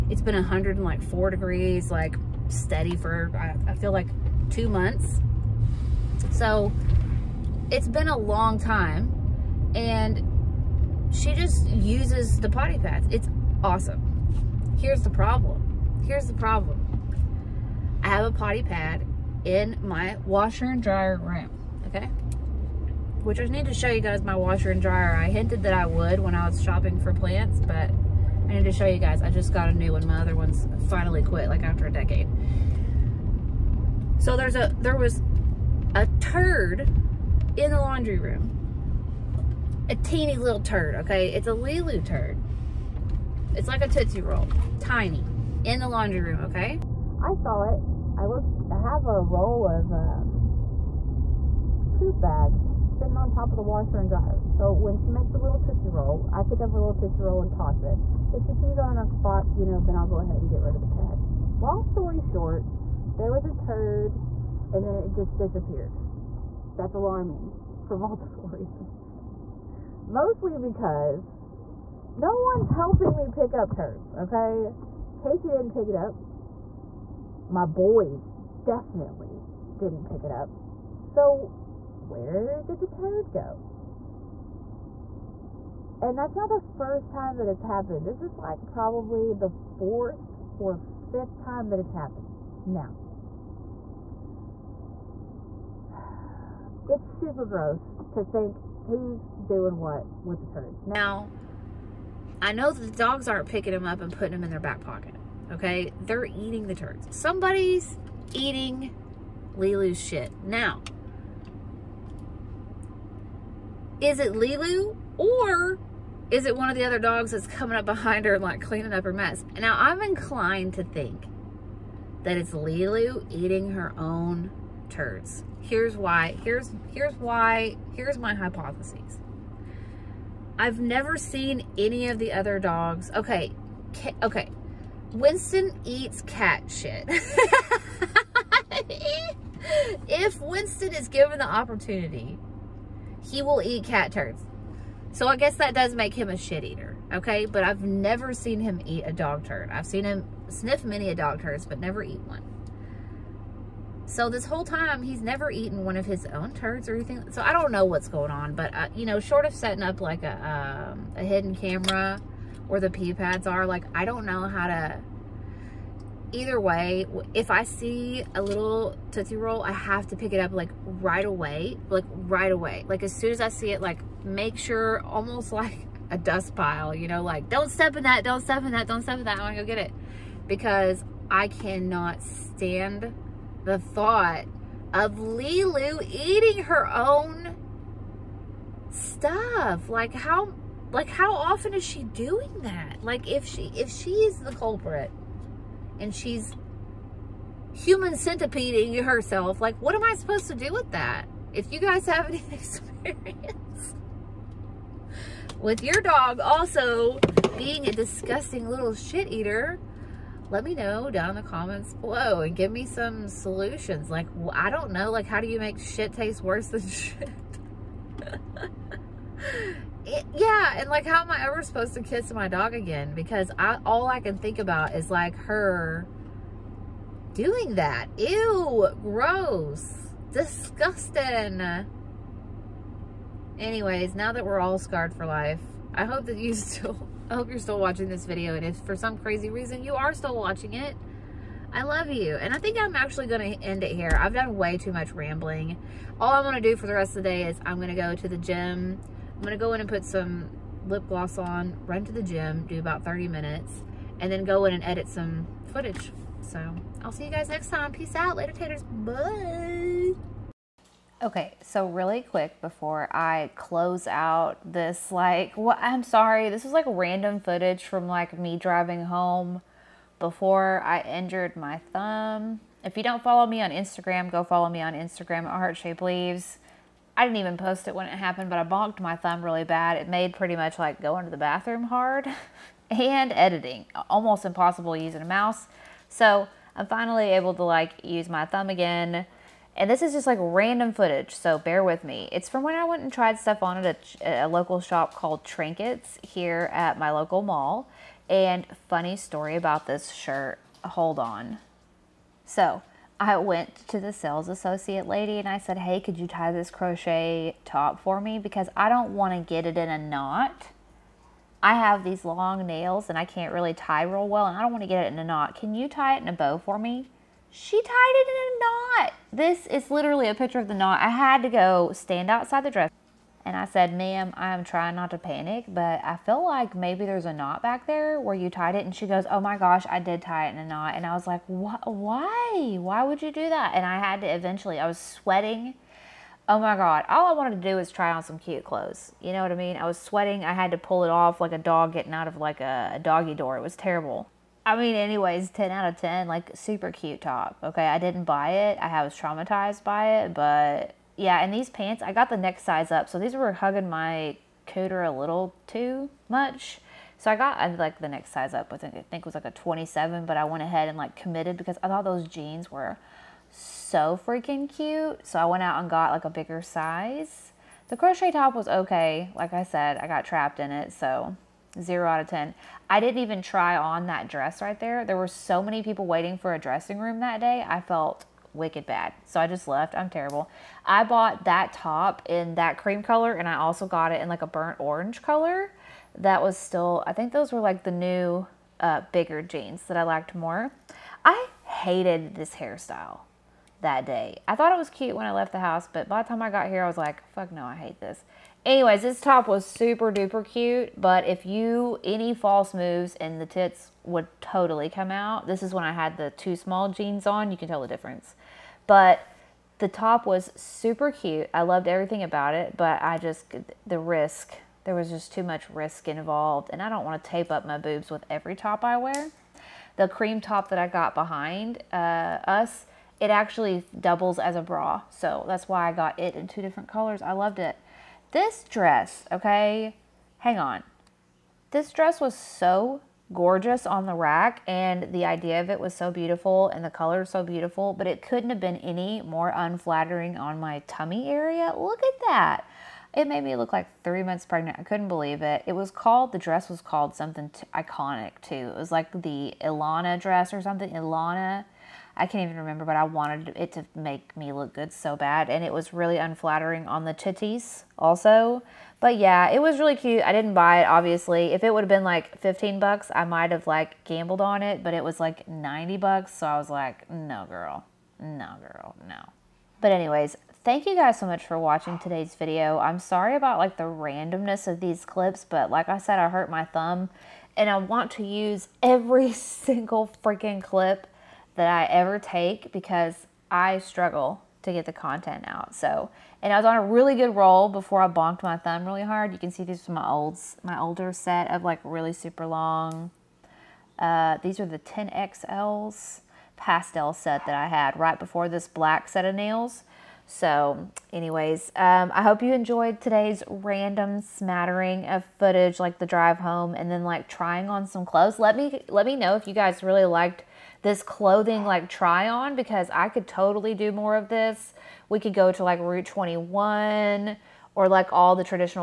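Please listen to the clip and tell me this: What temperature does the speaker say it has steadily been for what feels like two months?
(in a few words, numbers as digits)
104 degrees.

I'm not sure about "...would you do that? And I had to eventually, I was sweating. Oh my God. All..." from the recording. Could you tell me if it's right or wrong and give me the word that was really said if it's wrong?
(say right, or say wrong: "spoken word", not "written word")
right.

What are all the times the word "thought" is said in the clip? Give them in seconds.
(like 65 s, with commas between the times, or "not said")
183 s, 361 s, 394 s.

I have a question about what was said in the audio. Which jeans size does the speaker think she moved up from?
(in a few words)
27.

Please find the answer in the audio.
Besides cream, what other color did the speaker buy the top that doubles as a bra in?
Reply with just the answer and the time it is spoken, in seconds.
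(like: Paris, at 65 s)
burnt orange, at 384 s.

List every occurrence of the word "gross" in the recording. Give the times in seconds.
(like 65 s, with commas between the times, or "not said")
97 s, 229 s.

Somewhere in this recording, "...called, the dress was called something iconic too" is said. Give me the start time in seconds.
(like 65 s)
445 s.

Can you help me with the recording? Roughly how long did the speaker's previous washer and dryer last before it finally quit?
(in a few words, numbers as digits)
a decade.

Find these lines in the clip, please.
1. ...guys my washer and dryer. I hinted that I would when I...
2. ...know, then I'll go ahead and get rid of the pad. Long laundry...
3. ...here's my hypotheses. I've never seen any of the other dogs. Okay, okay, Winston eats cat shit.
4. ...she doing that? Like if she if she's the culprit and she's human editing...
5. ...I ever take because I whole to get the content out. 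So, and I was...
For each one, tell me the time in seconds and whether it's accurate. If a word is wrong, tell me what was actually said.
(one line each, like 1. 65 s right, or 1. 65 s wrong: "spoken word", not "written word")
1. 23 s right
2. 59 s wrong: "story", not "laundry"
3. 127 s right
4. 191 s wrong: "centipeding", not "editing"
5. 481 s wrong: "struggle", not "whole".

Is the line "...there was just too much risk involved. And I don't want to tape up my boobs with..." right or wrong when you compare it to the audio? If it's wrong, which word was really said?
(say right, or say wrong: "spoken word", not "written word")
right.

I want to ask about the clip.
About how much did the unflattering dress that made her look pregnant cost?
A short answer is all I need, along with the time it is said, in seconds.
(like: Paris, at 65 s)
90 bucks, at 465 s.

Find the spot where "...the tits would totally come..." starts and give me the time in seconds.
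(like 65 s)
403 s.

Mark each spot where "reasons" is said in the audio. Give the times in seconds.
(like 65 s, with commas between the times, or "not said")
68 s, 239 s.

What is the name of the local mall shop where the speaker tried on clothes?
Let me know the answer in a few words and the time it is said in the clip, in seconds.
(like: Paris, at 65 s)
Trinkets, at 295 s.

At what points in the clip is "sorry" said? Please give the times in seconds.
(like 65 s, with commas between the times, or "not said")
266 s, 472 s.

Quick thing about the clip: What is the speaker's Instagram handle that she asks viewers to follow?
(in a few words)
Heart Shaped Leaves.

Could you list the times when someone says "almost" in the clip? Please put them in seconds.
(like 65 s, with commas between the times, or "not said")
175 s, 284 s.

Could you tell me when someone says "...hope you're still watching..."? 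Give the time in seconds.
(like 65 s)
237 s.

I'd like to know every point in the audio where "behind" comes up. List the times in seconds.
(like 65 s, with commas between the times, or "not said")
117 s, 421 s.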